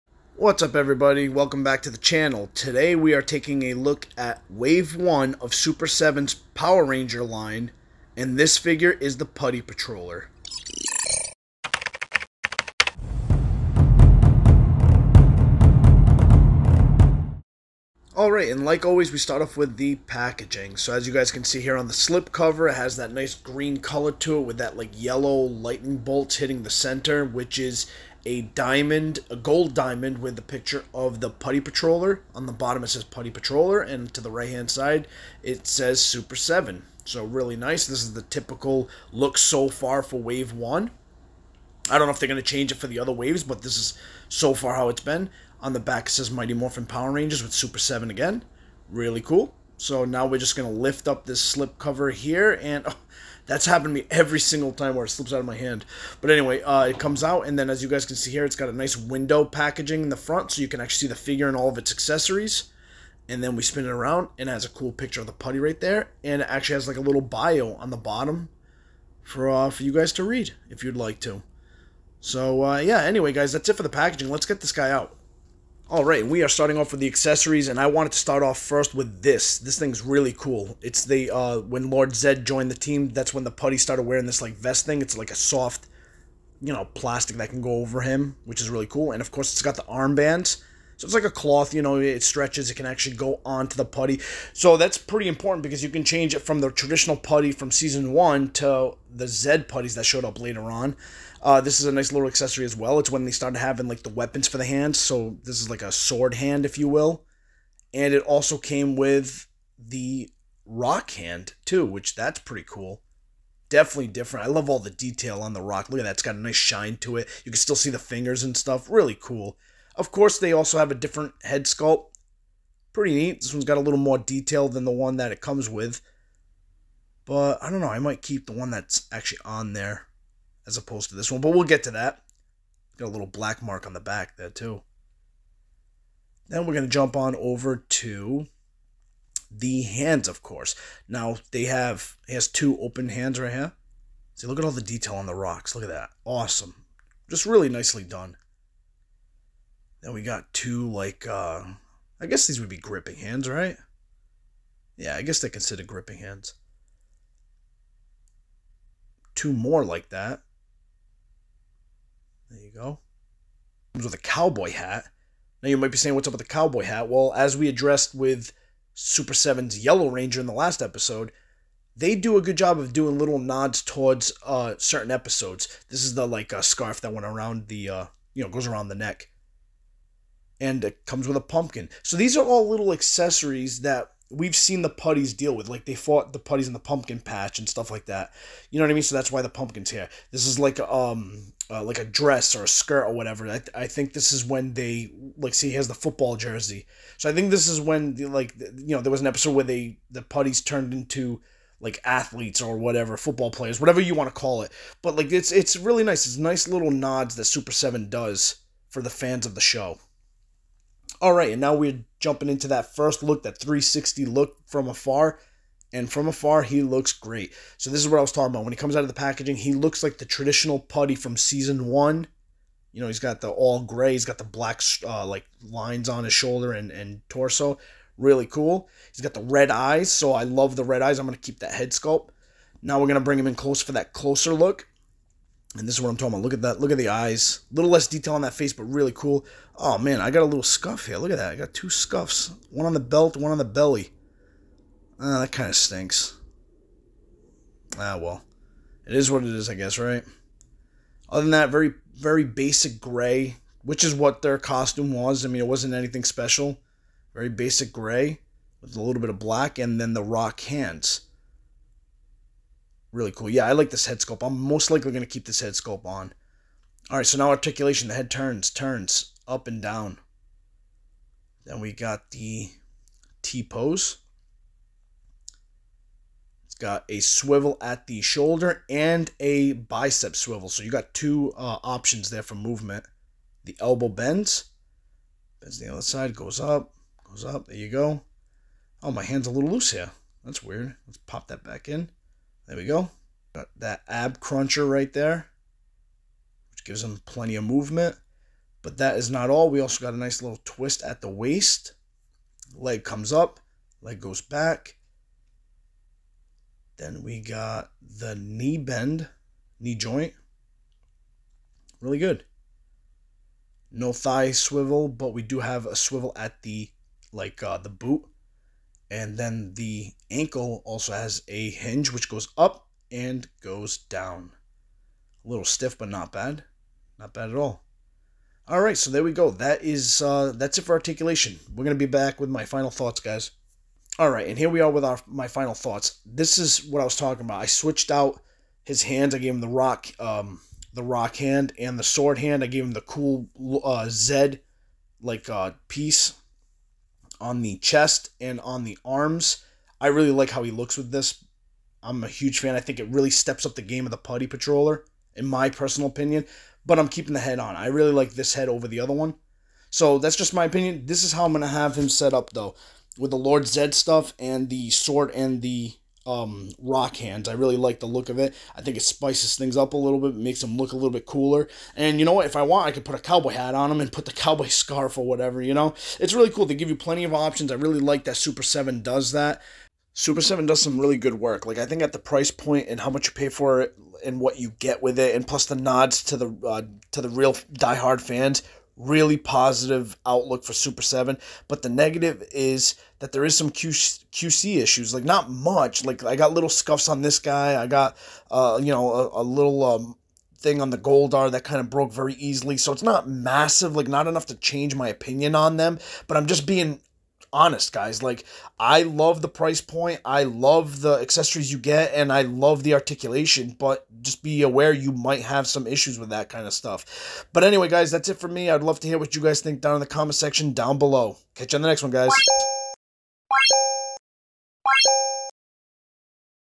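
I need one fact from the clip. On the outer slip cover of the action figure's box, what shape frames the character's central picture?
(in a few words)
Gold diamond.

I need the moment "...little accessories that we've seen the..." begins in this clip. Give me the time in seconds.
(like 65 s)
182 s.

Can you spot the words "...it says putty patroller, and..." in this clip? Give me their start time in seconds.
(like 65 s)
32 s.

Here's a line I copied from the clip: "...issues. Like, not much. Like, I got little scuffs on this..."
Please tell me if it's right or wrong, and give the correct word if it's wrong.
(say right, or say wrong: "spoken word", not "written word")
right.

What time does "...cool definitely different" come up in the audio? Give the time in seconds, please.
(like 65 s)
112 s.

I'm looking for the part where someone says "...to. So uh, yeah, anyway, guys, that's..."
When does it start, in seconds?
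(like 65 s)
71 s.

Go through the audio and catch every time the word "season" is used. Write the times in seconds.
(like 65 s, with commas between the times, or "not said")
97 s, 221 s.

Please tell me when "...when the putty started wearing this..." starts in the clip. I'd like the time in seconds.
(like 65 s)
83 s.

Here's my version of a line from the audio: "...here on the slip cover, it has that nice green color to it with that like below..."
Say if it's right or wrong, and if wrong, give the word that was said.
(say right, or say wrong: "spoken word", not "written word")
wrong: "yellow", not "below".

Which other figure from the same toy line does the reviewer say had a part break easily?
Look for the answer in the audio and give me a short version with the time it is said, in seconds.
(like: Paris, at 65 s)
Goldar, at 400 s.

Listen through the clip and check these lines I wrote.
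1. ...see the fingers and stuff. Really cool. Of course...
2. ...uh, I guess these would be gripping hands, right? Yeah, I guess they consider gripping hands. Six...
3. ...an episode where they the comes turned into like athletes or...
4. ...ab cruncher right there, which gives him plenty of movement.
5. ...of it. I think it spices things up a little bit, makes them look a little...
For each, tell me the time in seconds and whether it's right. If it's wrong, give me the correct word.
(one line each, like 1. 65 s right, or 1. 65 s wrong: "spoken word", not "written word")
1. 117 s right
2. 151 s wrong: "Two", not "Six"
3. 199 s wrong: "putties", not "comes"
4. 294 s right
5. 368 s right.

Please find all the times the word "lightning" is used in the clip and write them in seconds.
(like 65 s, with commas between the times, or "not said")
25 s.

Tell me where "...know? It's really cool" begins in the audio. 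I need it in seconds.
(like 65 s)
375 s.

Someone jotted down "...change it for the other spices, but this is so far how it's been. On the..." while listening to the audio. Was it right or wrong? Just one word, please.
wrong.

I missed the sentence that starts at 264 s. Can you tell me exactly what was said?
I'm most likely going to keep this head sculpt on.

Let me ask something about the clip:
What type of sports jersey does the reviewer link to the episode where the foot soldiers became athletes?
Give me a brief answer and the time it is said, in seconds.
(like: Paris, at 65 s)
Football jersey, at 195 s.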